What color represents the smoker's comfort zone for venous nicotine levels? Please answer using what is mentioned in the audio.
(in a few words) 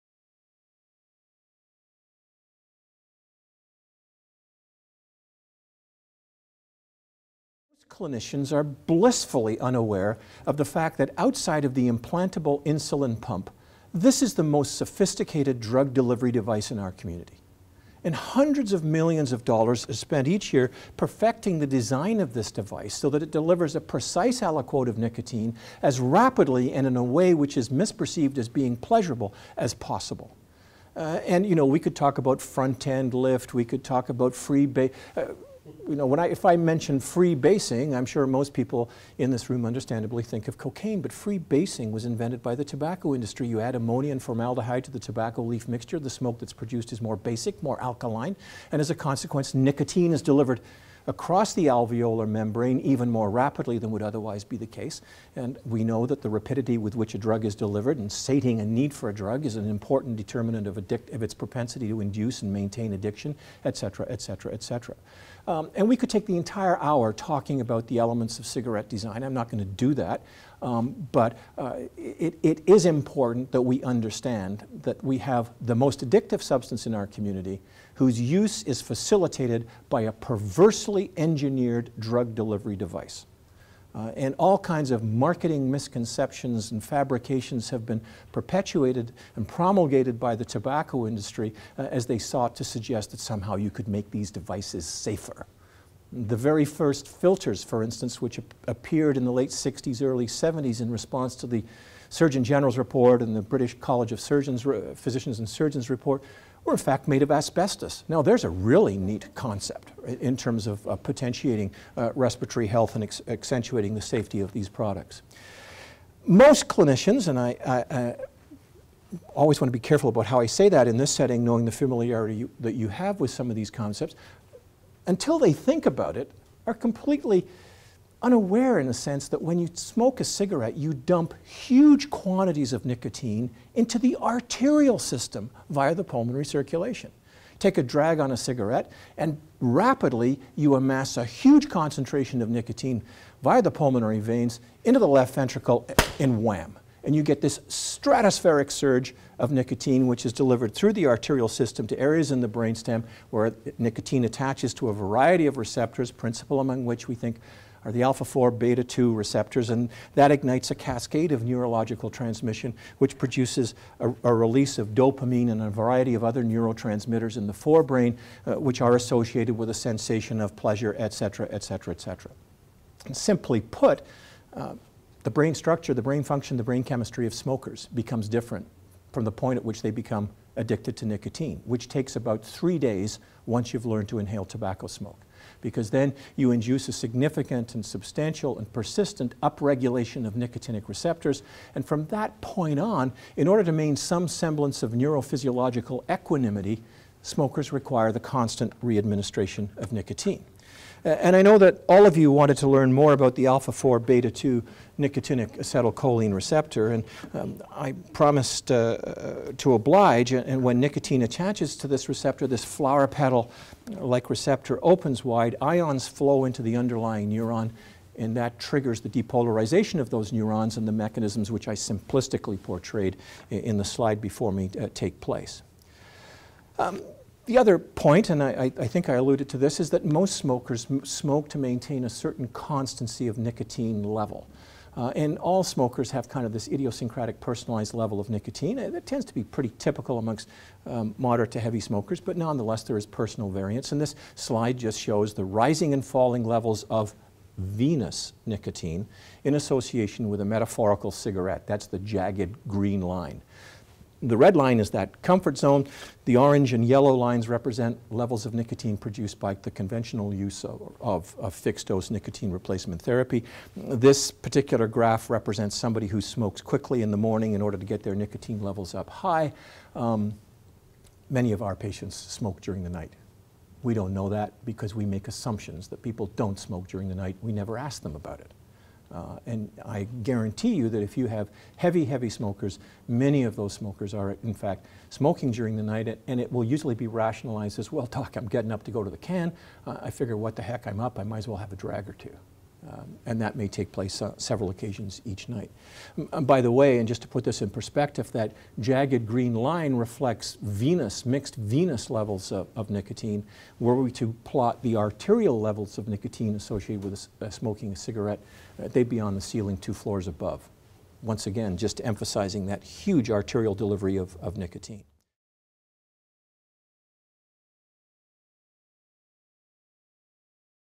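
Red.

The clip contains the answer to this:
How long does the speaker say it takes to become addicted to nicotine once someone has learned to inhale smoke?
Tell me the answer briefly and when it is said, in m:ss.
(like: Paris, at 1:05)
3 days, at 3:02.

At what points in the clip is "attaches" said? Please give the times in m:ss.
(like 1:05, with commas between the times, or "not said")
2:34, 3:31.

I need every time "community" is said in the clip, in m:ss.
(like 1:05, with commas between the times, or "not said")
0:16, 1:17.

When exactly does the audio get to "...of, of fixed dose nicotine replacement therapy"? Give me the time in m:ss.
4:21.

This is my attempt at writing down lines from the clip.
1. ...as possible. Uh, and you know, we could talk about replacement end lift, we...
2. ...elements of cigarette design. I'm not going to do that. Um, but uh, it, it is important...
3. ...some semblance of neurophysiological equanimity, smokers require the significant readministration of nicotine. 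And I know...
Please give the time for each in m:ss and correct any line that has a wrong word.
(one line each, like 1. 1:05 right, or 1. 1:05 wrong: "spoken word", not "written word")
1. 0:29 wrong: "front", not "replacement"
2. 1:07 right
3. 3:13 wrong: "constant", not "significant".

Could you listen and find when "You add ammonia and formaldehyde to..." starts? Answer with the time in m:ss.
0:43.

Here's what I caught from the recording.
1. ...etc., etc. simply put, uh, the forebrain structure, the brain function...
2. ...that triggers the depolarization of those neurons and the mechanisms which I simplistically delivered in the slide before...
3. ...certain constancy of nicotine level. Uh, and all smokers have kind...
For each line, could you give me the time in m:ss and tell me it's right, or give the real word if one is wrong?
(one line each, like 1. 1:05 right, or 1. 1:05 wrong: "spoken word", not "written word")
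1. 2:51 wrong: "brain", not "forebrain"
2. 3:38 wrong: "portrayed", not "delivered"
3. 3:52 right.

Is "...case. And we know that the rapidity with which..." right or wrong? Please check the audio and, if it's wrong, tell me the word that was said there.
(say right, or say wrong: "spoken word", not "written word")
right.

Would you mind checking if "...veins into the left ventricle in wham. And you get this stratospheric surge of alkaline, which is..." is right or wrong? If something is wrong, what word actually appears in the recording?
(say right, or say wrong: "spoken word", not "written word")
wrong: "nicotine", not "alkaline".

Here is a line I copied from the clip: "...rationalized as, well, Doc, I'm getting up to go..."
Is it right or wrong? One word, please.
right.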